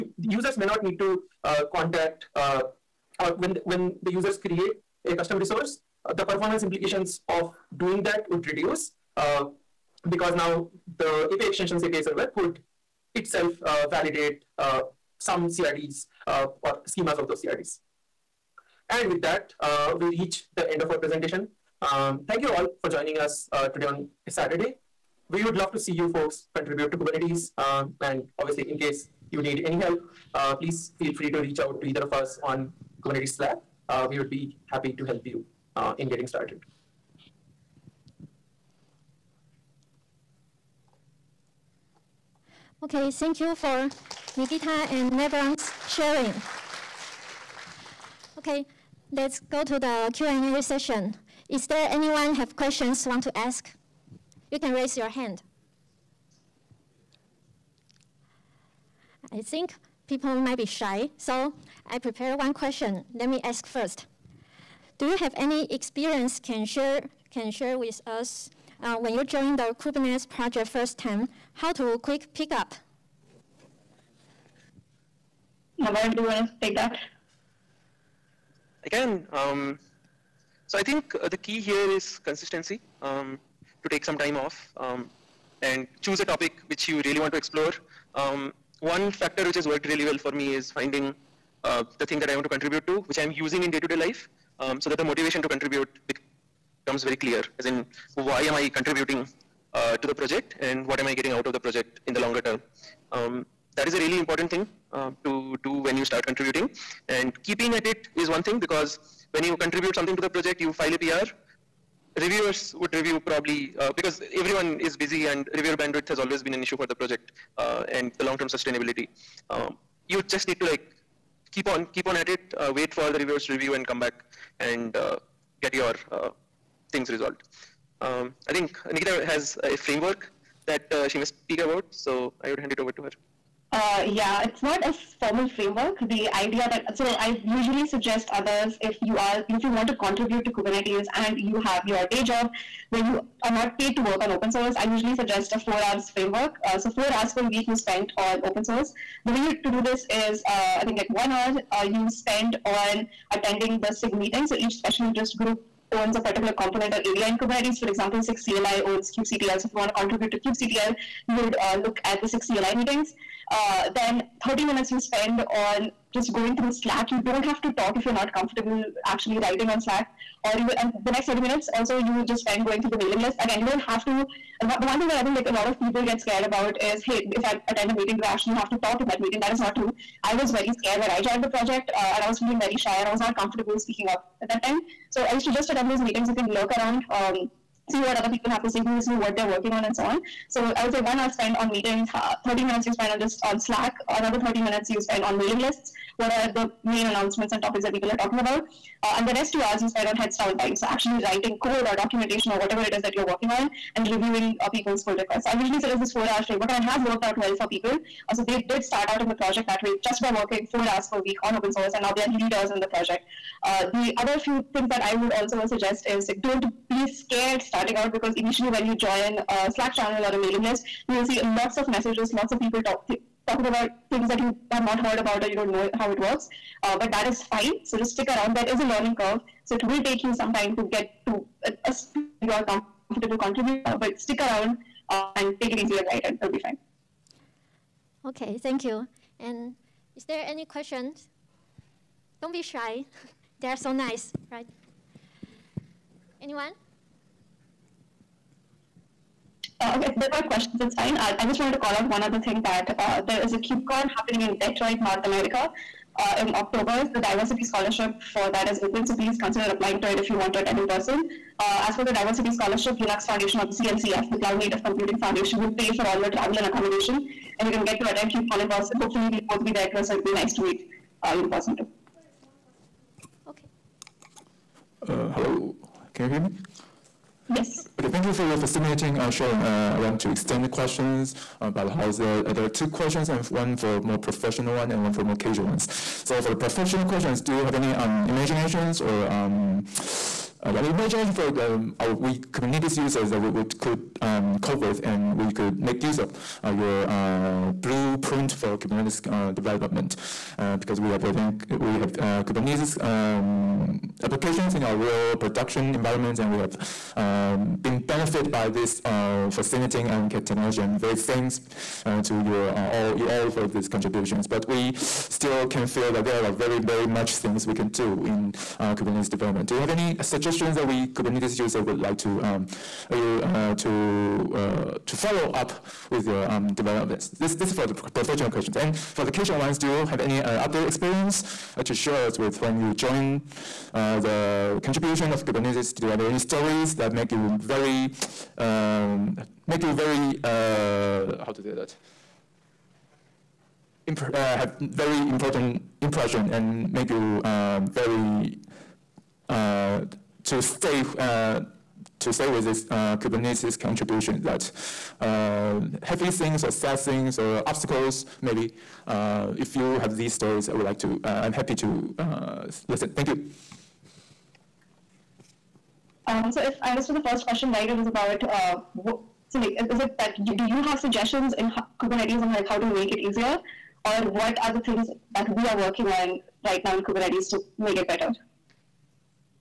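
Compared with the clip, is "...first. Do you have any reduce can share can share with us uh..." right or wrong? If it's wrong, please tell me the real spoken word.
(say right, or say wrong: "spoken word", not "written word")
wrong: "experience", not "reduce".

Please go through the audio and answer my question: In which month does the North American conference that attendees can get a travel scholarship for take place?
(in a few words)
October.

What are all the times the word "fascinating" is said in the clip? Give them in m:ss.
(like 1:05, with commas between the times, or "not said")
4:38, 5:09.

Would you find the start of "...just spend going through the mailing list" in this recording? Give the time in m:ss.
2:52.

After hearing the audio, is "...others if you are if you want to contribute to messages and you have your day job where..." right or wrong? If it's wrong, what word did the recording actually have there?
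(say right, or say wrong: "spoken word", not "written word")
wrong: "kubernetes", not "messages".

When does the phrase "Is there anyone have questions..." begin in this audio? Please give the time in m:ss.
0:51.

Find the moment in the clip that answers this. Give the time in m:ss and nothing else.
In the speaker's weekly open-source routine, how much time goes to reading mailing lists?
3:14.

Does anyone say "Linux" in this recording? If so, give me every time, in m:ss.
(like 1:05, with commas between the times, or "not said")
4:22.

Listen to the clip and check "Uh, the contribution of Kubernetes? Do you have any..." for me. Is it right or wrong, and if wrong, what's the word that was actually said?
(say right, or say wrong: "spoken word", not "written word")
right.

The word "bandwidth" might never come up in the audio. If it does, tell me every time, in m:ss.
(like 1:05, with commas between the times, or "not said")
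1:55.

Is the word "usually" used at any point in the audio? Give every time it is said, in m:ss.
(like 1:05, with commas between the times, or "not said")
2:17, 2:24, 3:25.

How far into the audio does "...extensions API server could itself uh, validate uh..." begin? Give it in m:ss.
0:11.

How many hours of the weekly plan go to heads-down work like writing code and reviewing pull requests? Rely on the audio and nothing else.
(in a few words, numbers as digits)
2 hours.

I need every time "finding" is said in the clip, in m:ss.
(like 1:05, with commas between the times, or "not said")
1:30.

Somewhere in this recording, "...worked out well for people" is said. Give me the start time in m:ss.
3:27.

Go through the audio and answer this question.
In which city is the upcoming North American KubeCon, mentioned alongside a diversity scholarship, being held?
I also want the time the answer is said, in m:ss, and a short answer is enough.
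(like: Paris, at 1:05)
Detroit, at 4:14.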